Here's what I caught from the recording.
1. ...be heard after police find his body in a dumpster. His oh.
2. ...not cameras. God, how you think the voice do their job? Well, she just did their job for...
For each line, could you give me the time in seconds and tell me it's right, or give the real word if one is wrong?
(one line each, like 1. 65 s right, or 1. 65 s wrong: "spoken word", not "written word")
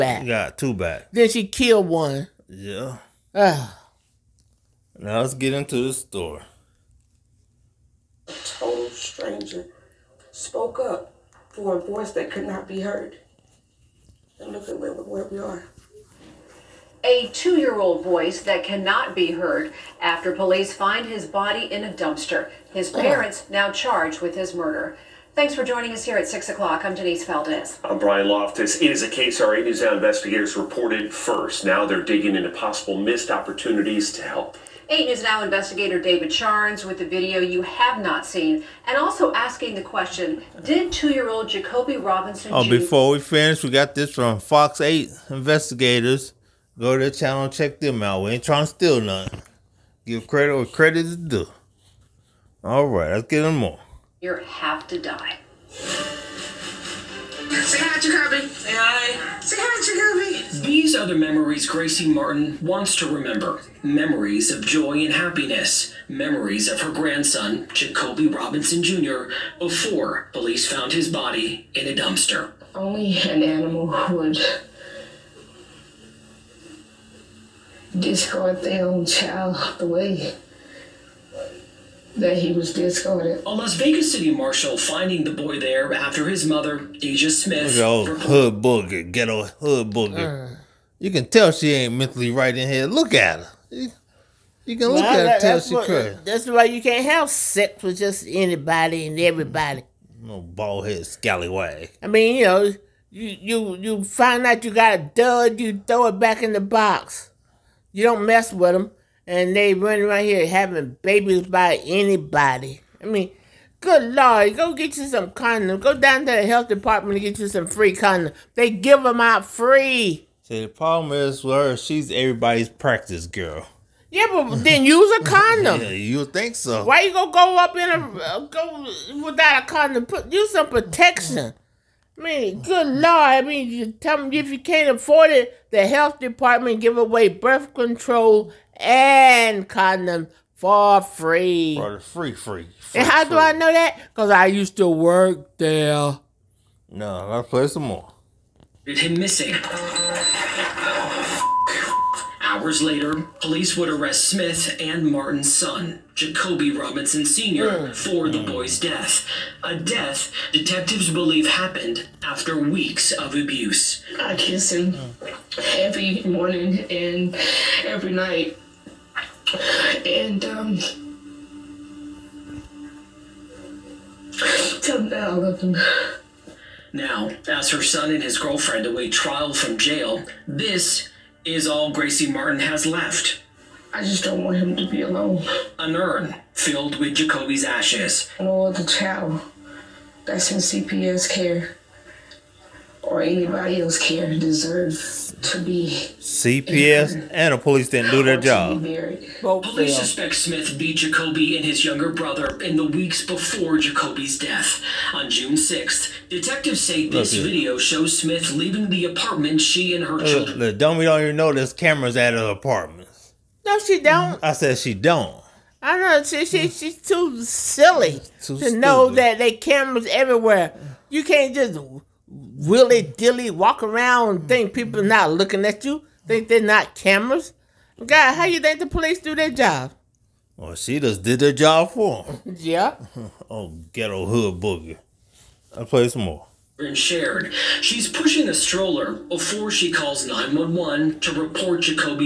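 1. 19 s right
2. 226 s wrong: "police", not "voice".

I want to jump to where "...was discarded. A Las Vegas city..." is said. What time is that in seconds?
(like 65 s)
82 s.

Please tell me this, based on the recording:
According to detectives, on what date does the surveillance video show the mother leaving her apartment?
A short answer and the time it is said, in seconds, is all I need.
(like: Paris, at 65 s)
June 6th, at 205 s.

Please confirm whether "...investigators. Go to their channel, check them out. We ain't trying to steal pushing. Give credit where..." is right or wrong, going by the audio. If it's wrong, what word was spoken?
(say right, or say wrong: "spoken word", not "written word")
wrong: "nothing", not "pushing".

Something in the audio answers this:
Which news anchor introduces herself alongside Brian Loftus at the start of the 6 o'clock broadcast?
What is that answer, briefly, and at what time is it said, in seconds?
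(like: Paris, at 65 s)
Denise Valdez, at 26 s.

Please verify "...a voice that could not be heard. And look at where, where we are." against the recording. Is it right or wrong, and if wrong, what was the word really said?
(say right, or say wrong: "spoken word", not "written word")
right.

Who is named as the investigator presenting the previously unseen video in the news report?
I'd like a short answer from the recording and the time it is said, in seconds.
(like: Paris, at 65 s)
David Charns, at 36 s.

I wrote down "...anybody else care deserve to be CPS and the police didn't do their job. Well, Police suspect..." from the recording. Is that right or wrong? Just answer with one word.
right.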